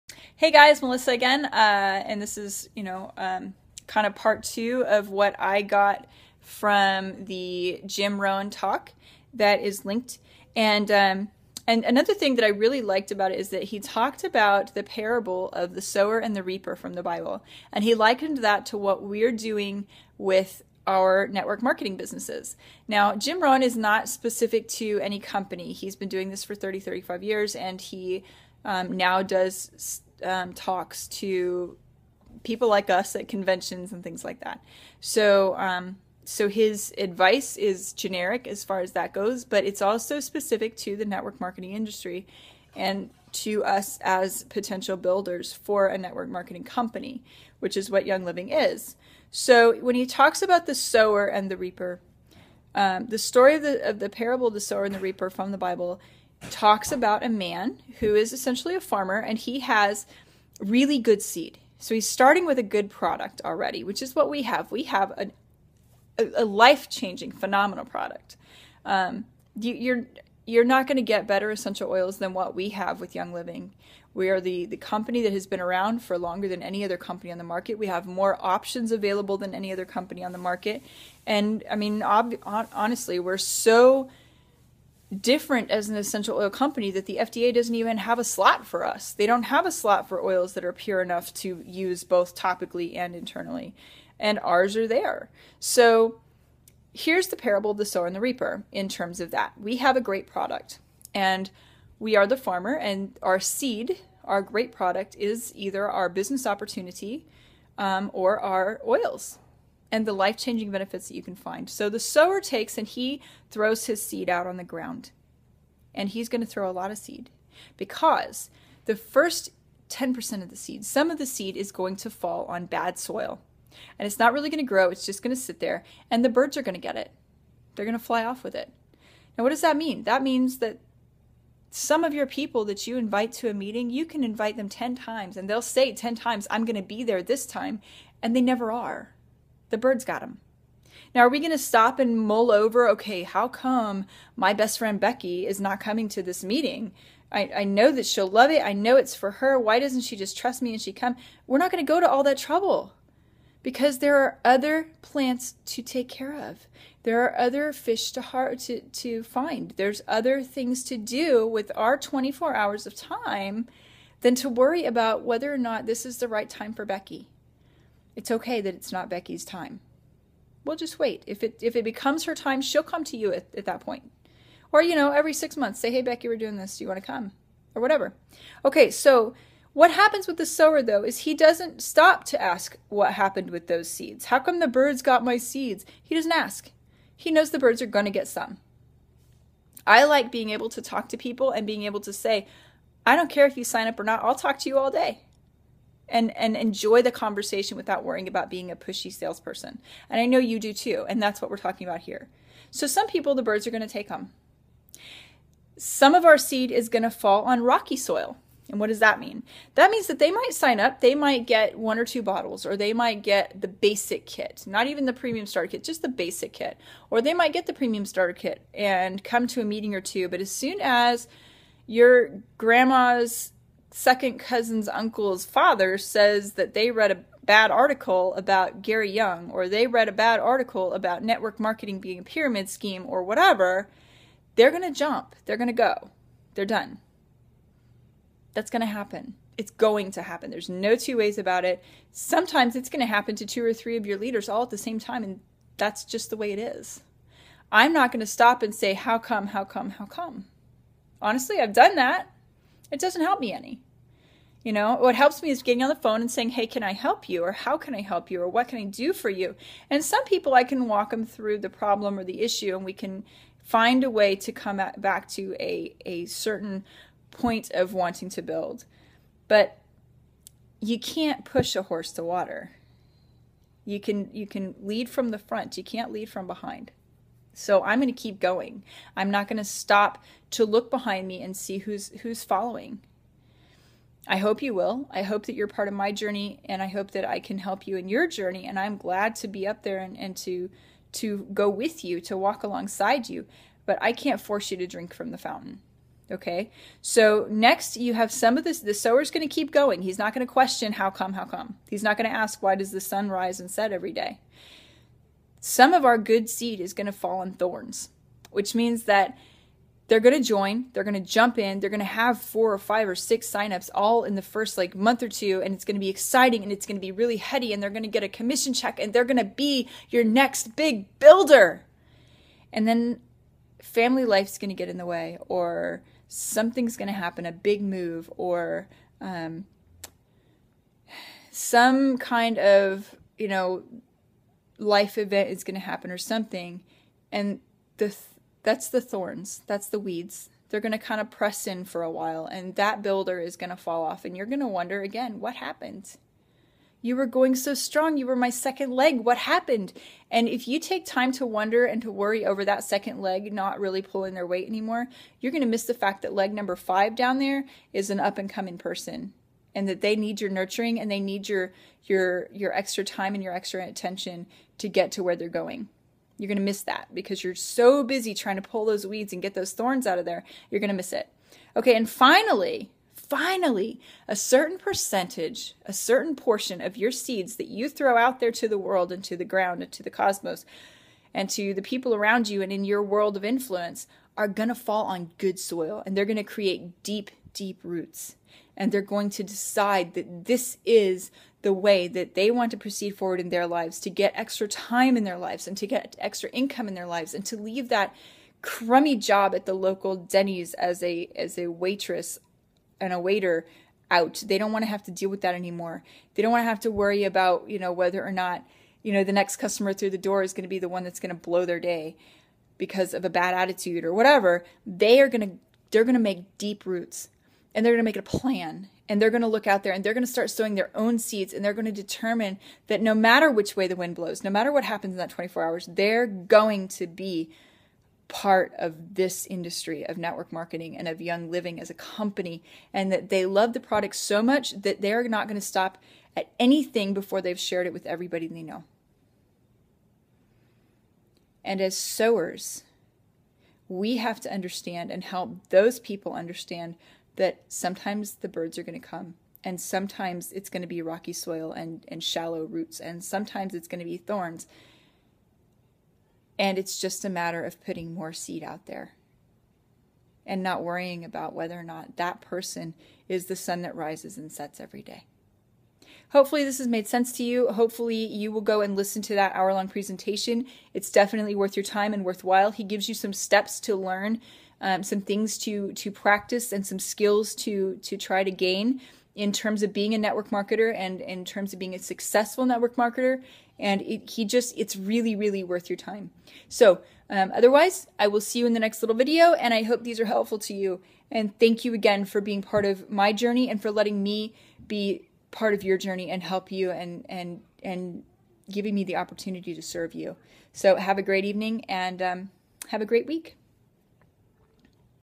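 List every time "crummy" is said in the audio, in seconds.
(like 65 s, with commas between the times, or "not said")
398 s.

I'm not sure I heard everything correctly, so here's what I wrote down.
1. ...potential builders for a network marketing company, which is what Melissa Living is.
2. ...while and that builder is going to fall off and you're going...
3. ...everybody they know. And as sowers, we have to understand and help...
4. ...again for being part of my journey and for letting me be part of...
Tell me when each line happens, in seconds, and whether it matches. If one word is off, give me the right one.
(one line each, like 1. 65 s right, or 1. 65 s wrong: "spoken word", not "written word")
1. 44 s wrong: "Young", not "Melissa"
2. 342 s right
3. 438 s right
4. 491 s right.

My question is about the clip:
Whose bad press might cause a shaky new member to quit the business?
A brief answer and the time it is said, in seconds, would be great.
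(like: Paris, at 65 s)
Gary Young, at 228 s.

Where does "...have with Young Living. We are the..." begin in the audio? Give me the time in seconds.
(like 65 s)
72 s.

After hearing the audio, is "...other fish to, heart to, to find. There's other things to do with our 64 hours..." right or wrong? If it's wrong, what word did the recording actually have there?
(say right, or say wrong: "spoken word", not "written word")
wrong: "24", not "64".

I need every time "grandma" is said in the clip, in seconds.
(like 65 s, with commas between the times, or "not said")
222 s.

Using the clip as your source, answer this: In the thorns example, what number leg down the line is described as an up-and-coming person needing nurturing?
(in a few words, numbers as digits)
5.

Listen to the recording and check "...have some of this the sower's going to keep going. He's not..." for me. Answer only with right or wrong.
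right.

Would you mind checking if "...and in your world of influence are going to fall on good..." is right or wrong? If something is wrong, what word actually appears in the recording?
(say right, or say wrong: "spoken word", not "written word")
right.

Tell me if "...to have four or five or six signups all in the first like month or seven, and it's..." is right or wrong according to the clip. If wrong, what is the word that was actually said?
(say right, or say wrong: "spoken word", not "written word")
wrong: "two", not "seven".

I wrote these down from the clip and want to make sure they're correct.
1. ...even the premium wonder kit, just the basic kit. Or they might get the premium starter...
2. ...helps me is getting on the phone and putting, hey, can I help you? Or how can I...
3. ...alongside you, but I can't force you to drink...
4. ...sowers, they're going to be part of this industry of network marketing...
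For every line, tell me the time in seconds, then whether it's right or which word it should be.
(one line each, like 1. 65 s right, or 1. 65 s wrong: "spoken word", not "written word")
1. 214 s wrong: "starter", not "wonder"
2. 255 s wrong: "saying", not "putting"
3. 292 s right
4. 425 s wrong: "hours", not "sowers".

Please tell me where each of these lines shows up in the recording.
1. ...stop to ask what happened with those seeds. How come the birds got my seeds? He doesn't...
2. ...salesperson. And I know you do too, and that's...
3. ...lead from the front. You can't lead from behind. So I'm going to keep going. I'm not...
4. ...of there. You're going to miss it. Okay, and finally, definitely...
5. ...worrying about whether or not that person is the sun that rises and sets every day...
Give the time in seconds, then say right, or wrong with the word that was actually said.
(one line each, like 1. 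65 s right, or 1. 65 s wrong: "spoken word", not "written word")
1. 181 s right
2. 199 s right
3. 274 s right
4. 370 s wrong: "finally", not "definitely"
5. 460 s right.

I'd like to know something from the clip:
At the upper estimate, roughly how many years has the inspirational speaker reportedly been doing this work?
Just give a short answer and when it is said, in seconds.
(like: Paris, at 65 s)
35, at 26 s.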